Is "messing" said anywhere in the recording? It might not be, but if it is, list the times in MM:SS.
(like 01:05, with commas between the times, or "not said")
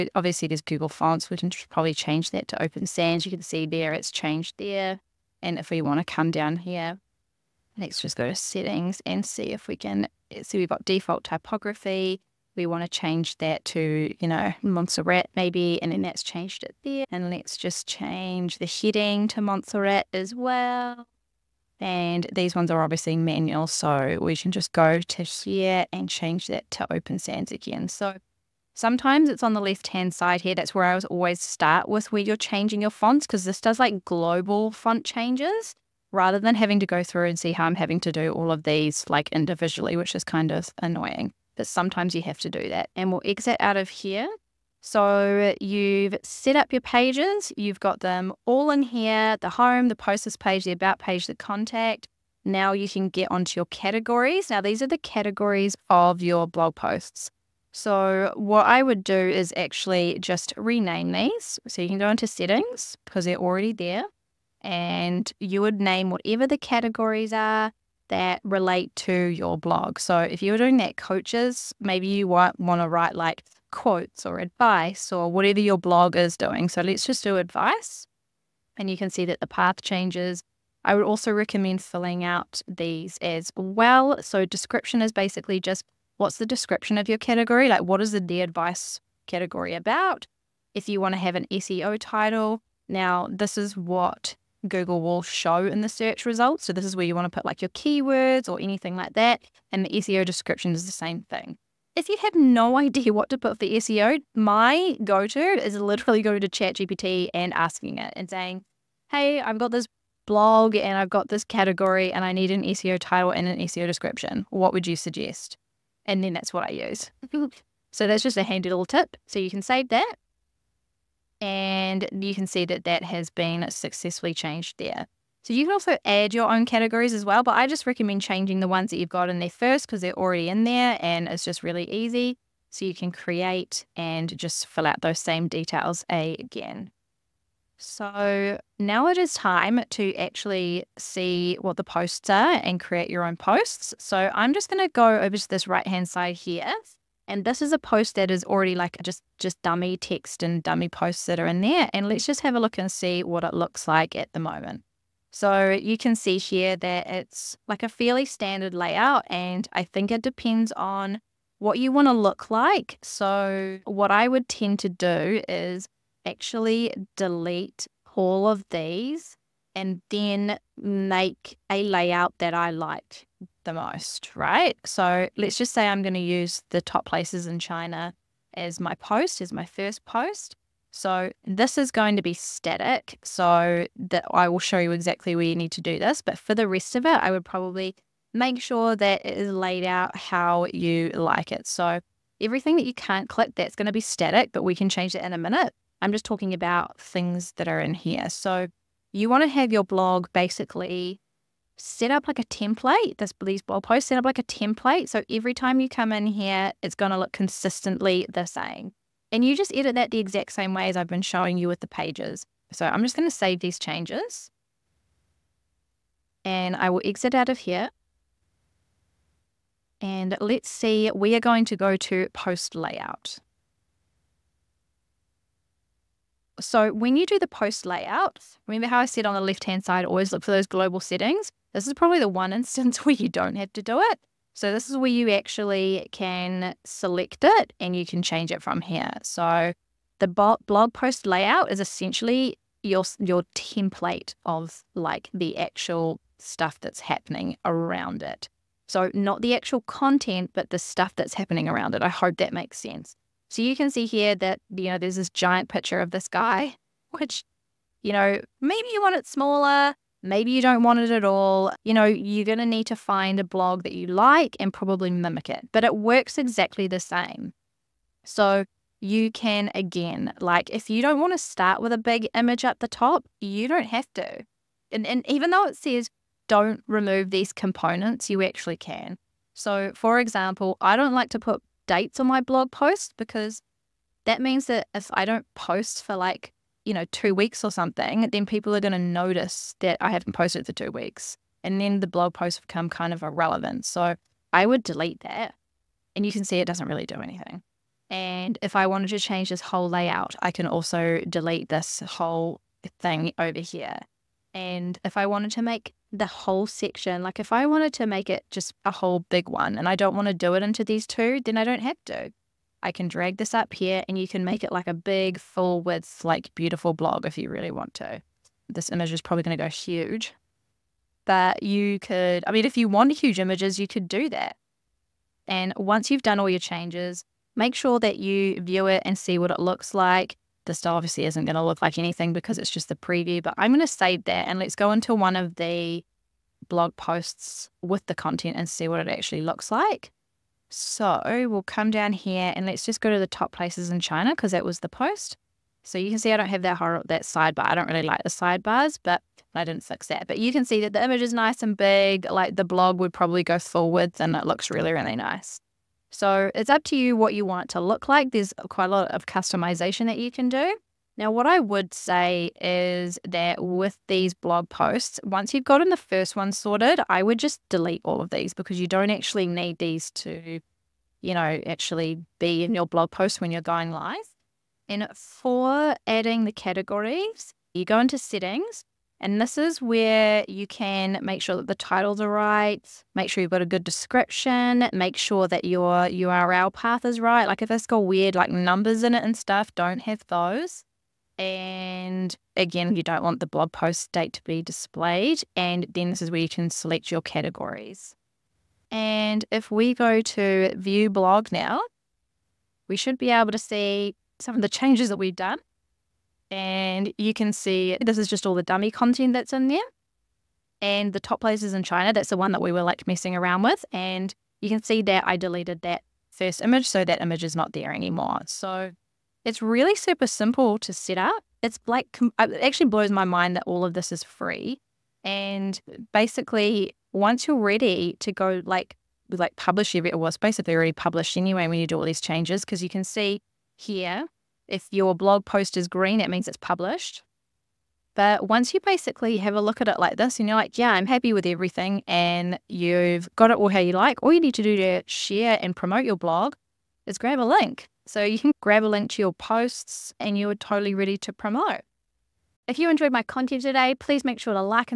06:53.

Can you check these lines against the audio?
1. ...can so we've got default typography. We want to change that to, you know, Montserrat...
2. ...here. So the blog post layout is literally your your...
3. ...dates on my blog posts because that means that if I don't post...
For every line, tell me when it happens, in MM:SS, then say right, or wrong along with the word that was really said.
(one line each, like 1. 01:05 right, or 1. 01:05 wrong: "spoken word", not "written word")
1. 00:09 right
2. 03:58 wrong: "essentially", not "literally"
3. 04:41 right.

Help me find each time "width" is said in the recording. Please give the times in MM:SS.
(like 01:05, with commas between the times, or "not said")
05:15, 05:53.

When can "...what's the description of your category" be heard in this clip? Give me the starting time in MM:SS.
01:26.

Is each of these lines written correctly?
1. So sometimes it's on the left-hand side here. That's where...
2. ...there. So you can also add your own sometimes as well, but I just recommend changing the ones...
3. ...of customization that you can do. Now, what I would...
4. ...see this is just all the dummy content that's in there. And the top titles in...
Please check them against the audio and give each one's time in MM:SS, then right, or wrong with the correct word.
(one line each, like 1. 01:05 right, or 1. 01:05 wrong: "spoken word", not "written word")
1. 00:27 right
2. 02:04 wrong: "categories", not "sometimes"
3. 05:59 right
4. 06:47 wrong: "places", not "titles".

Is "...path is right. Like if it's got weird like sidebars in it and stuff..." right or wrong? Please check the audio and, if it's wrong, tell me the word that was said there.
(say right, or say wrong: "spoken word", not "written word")
wrong: "numbers", not "sidebars".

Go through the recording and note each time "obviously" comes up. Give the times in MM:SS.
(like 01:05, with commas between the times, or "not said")
00:00, 00:22, 05:30.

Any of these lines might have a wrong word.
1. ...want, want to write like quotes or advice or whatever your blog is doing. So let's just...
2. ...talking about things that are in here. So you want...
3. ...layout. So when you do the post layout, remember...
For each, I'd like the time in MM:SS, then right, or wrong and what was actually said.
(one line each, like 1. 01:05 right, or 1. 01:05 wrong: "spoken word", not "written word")
1. 01:12 right
2. 03:16 right
3. 03:42 right.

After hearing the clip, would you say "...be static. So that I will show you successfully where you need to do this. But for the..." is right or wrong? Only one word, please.
wrong.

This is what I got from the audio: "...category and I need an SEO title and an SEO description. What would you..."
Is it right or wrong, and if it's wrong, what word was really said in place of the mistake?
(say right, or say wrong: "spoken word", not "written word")
right.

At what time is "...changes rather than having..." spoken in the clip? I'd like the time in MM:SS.
00:35.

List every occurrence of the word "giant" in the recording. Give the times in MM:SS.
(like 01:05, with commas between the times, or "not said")
04:15.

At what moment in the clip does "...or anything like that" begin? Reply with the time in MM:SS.
01:38.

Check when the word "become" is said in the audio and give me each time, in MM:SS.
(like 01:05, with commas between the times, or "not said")
04:52.